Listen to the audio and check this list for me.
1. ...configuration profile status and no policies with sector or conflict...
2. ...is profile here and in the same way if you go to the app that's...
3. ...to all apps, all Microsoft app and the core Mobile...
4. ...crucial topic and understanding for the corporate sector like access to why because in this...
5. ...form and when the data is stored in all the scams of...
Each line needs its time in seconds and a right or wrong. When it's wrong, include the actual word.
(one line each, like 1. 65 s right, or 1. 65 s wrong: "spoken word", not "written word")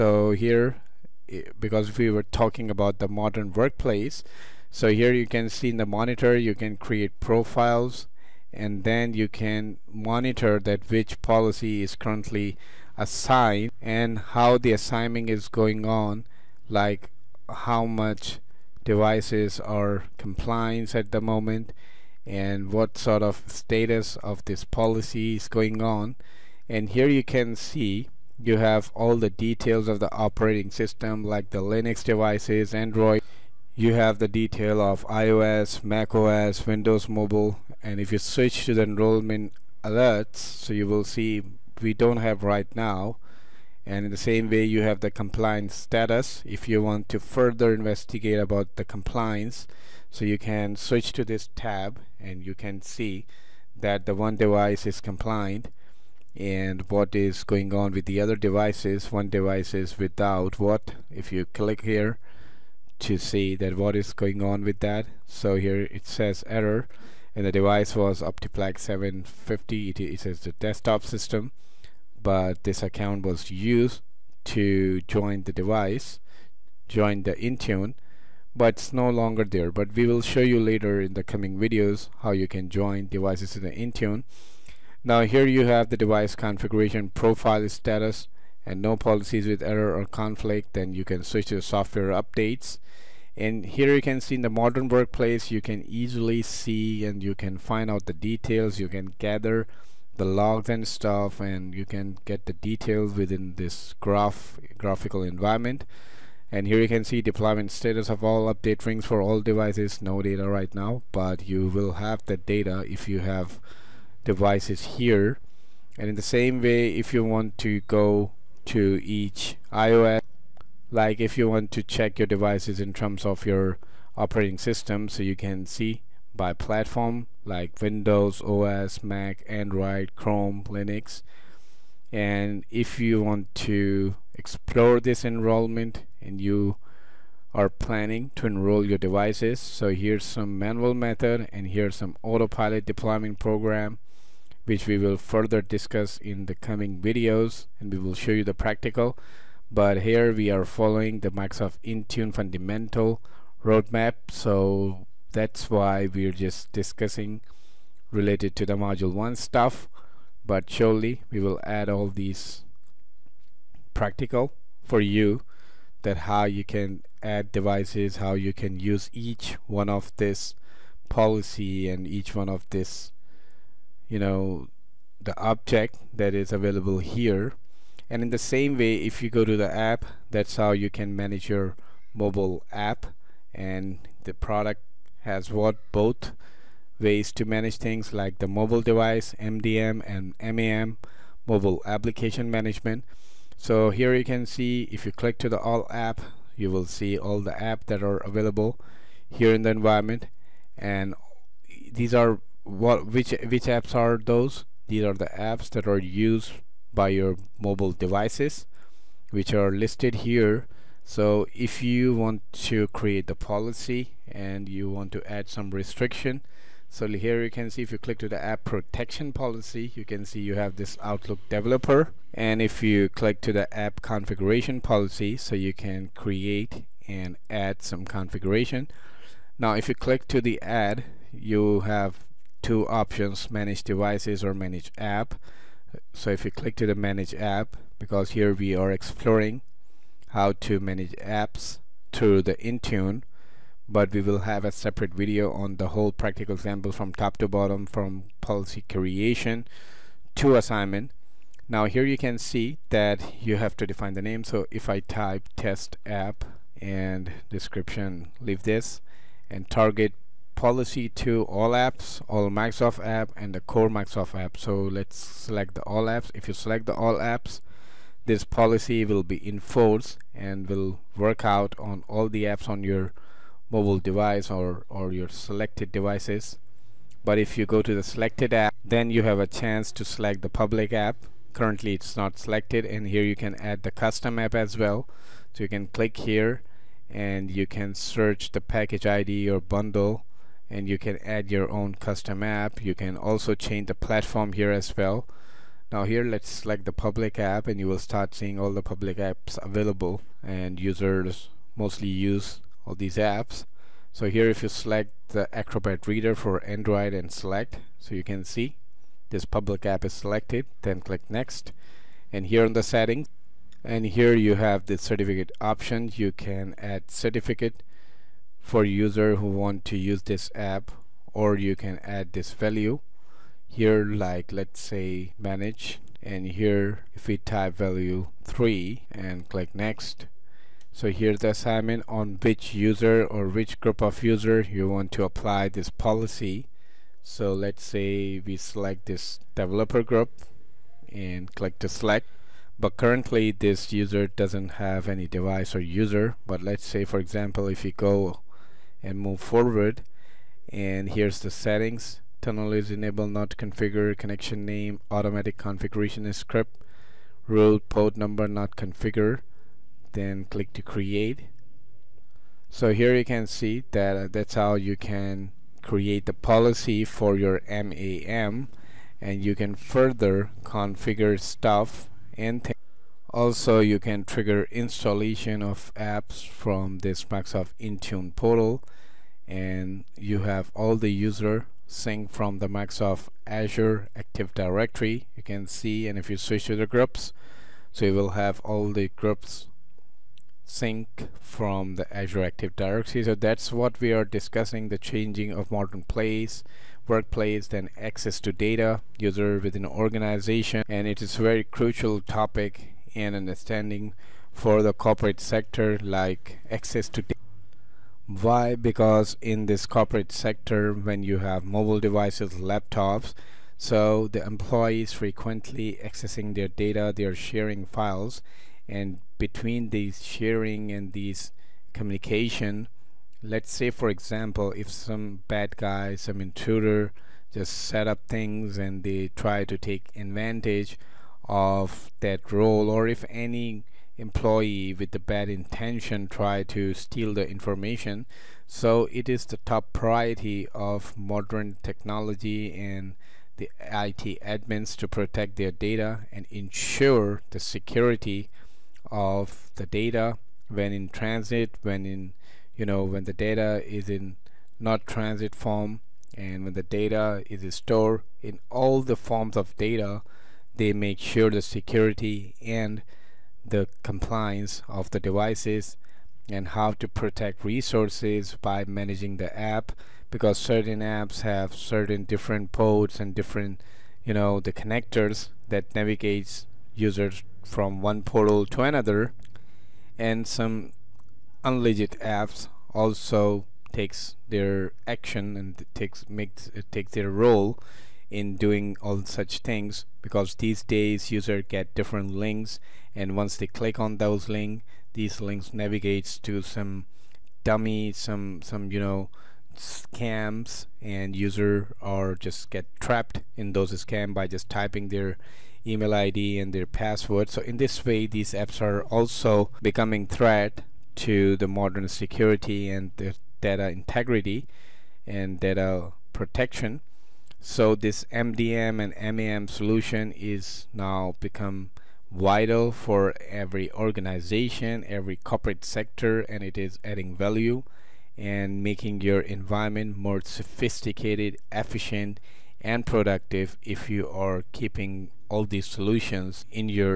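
1. 86 s wrong: "error", not "sector"
2. 176 s wrong: "available", not "profile"
3. 261 s wrong: "Microsoft", not "Mobile"
4. 401 s right
5. 455 s wrong: "forms", not "scams".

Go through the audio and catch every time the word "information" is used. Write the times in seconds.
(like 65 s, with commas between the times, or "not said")
437 s.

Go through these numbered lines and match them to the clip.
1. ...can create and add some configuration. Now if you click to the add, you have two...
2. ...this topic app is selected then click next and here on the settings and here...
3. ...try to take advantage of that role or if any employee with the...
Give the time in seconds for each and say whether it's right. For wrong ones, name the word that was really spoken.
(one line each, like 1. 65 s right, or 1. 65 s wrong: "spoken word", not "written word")
1. 225 s right
2. 309 s wrong: "public", not "topic"
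3. 429 s right.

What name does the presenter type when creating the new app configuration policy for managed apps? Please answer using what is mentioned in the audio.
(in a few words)
test app.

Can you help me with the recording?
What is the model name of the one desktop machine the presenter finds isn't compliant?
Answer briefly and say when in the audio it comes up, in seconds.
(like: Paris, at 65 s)
Optiplex 750, at 68 s.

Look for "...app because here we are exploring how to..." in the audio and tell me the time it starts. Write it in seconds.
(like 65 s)
237 s.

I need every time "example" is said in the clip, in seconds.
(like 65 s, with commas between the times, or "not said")
246 s, 347 s, 424 s.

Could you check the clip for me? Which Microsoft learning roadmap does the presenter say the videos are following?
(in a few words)
Microsoft Intune fundamental.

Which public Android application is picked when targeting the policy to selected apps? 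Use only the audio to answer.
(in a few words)
Acrobat Reader.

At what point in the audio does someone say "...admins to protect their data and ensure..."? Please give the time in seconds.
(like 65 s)
444 s.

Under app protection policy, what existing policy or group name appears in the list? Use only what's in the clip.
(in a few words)
Outlook developer.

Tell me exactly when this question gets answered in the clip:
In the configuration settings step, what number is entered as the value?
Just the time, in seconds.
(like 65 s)
328 s.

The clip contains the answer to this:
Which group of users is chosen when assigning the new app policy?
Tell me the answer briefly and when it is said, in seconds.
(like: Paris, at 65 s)
developer group, at 339 s.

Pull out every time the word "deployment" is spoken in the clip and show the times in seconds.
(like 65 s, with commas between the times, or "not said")
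107 s, 142 s.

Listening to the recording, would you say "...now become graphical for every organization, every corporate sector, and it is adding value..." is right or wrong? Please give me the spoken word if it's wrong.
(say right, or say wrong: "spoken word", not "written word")
wrong: "vital", not "graphical".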